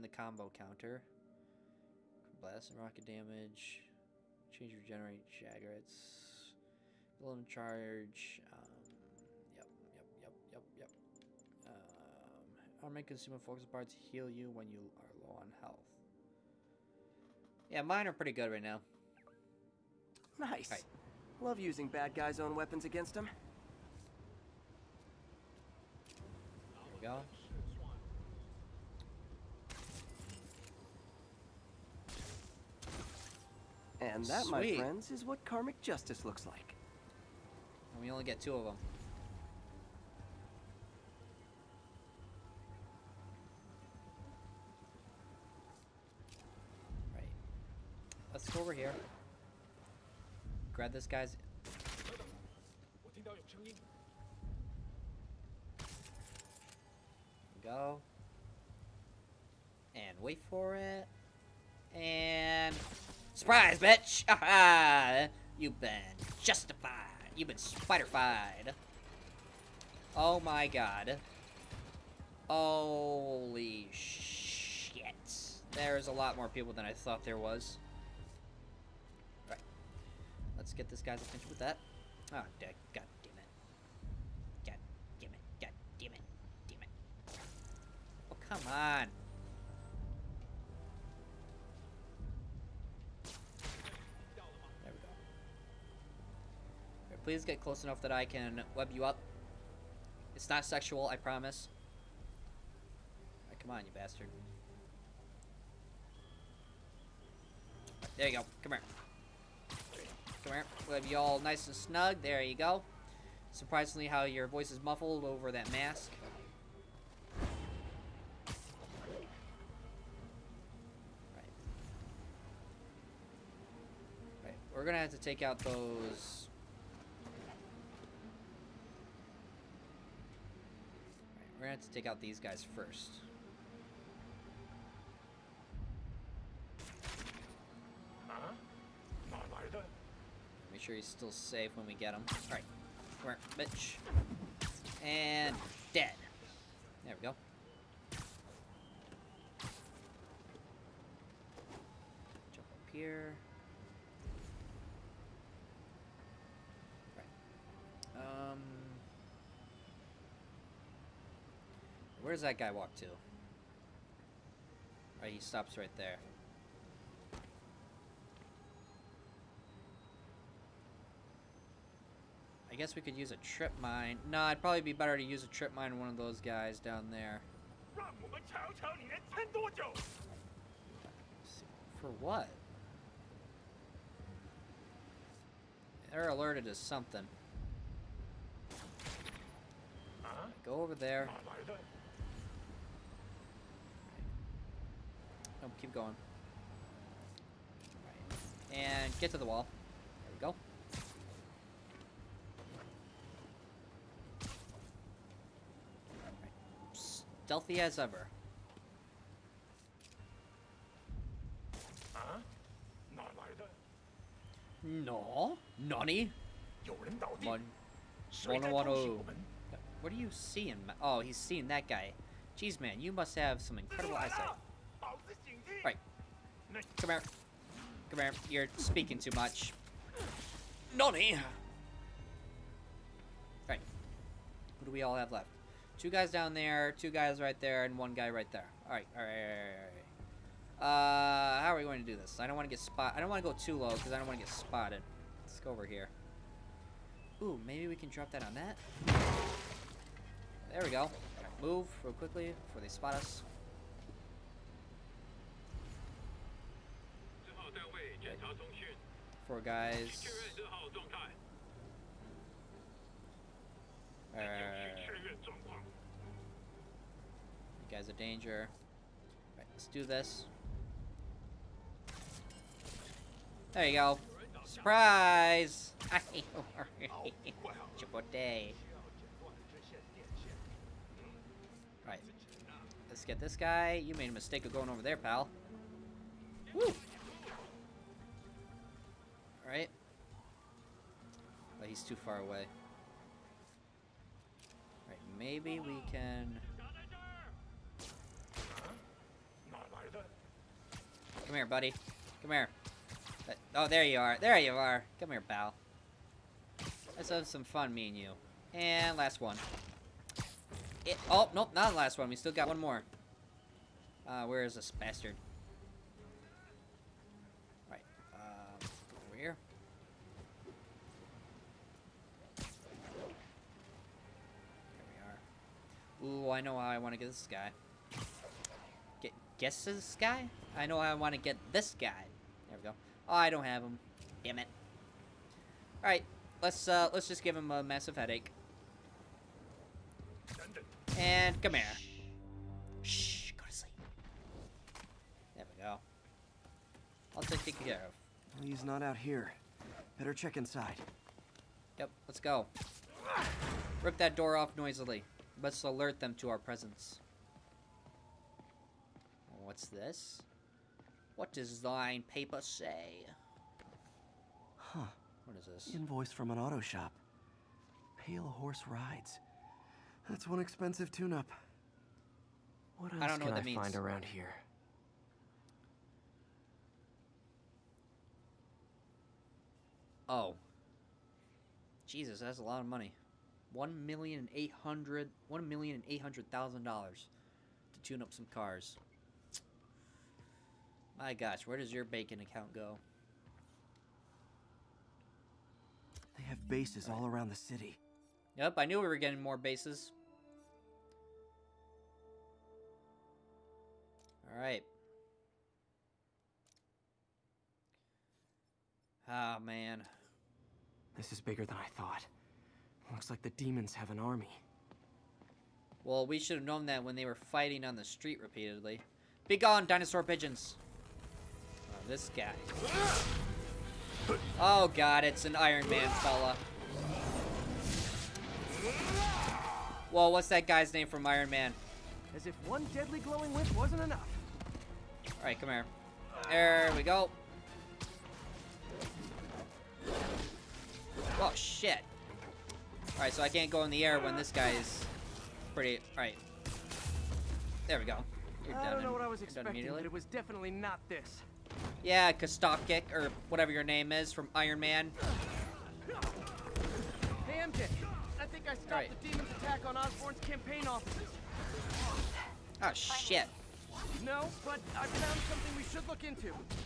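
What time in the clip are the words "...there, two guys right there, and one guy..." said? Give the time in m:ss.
3:56.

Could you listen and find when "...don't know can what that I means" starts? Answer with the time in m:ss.
6:13.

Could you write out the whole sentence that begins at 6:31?
My gosh, where does your bacon account go?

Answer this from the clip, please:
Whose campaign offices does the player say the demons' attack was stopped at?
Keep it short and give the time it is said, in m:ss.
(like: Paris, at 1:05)
Osborn, at 7:39.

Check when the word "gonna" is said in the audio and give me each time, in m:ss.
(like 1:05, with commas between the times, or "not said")
2:04, 2:11.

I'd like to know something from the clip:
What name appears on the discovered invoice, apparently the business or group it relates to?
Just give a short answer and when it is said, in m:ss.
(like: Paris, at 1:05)
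Pale Horse Rides, at 6:08.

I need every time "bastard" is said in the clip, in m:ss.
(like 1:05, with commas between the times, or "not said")
1:43, 5:14.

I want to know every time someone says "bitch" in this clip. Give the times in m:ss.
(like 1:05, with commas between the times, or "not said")
1:03, 2:23.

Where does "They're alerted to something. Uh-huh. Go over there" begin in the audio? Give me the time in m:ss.
3:06.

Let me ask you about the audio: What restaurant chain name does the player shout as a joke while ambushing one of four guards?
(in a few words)
Chipotle.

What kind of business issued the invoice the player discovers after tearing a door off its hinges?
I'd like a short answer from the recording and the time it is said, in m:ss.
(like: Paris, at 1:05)
Auto shop, at 6:06.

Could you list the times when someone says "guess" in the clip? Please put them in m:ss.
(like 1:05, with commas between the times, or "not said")
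2:52, 5:29.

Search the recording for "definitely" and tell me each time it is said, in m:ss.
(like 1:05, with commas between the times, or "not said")
7:30.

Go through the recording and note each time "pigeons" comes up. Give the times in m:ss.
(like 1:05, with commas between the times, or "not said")
7:00.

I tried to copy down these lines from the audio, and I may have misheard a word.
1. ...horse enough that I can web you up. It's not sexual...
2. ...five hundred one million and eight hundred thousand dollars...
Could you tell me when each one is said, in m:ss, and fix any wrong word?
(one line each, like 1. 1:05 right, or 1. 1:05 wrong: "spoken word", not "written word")
1. 1:37 wrong: "close", not "horse"
2. 6:24 wrong: "eight", not "five".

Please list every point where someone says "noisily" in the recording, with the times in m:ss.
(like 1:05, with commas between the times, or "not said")
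5:54.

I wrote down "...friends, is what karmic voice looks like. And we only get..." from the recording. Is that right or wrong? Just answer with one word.
wrong.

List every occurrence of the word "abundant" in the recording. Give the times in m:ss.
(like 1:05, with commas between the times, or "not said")
not said.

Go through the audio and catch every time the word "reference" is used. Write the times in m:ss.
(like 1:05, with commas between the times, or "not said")
not said.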